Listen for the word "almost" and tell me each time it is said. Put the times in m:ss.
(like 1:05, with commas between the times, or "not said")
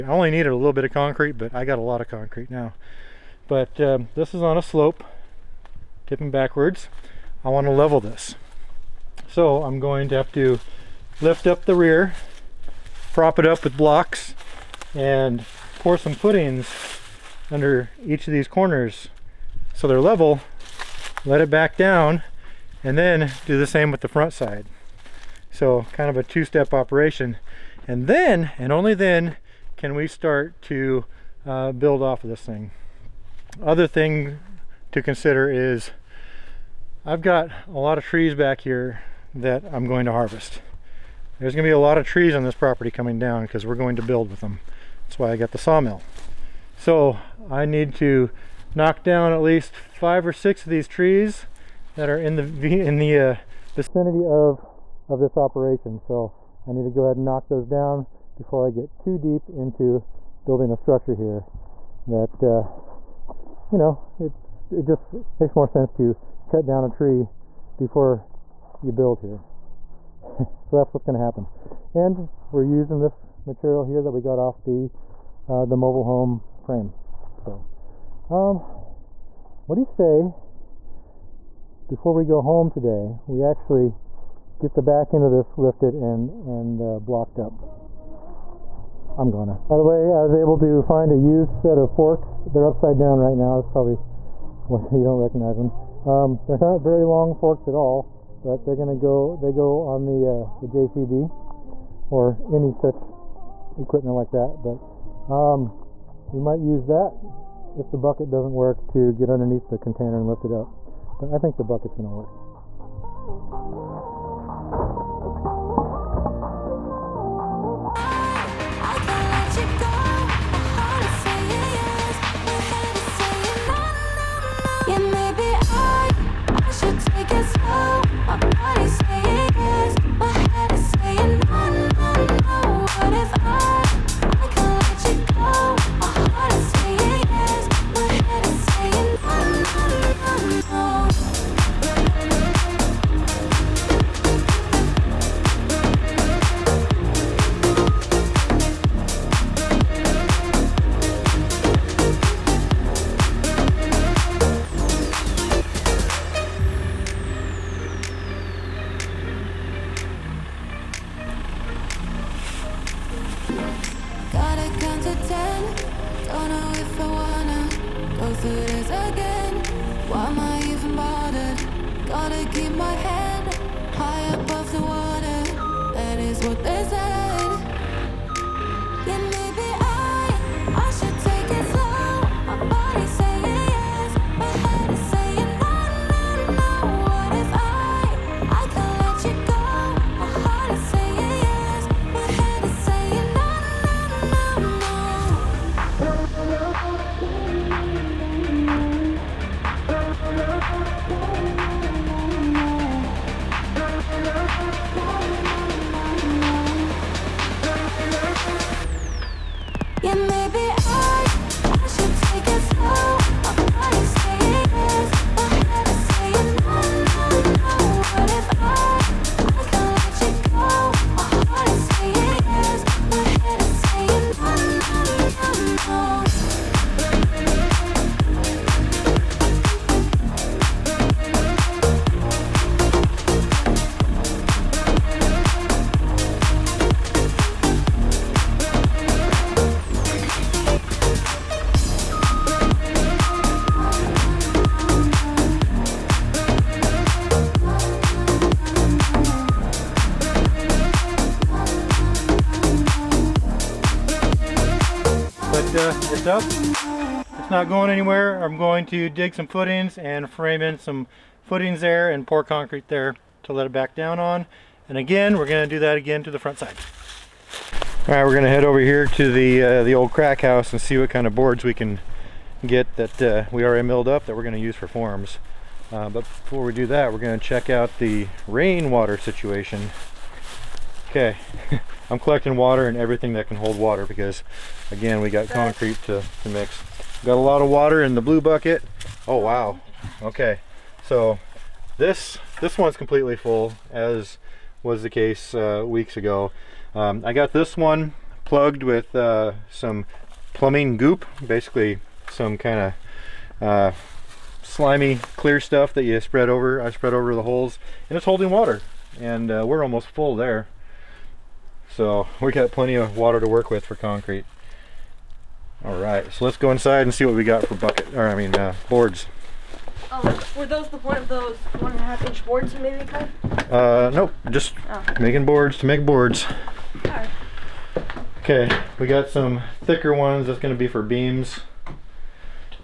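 5:09.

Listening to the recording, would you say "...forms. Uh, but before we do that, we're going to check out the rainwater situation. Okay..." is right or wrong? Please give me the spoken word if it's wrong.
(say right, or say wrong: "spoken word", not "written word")
right.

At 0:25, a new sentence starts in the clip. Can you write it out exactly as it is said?
So kind of a two-step operation.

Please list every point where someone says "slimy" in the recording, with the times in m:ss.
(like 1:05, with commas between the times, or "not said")
5:04.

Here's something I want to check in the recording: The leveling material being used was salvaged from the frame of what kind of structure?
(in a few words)
mobile home.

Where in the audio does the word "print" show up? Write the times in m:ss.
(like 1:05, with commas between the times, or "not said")
not said.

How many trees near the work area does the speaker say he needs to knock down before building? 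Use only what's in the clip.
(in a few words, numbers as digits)
5 or 6.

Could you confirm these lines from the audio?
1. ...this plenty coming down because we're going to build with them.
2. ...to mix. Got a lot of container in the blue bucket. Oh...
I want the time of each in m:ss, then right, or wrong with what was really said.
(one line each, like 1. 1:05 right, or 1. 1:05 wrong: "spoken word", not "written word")
1. 0:42 wrong: "property", not "plenty"
2. 4:46 wrong: "water", not "container".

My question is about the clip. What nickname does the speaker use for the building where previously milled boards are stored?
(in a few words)
the old crack house.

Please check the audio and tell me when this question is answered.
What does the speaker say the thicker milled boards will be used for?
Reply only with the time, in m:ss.
5:31.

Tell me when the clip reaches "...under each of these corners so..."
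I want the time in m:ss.
0:17.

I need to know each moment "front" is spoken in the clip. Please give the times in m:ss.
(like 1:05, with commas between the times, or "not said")
0:24, 4:26.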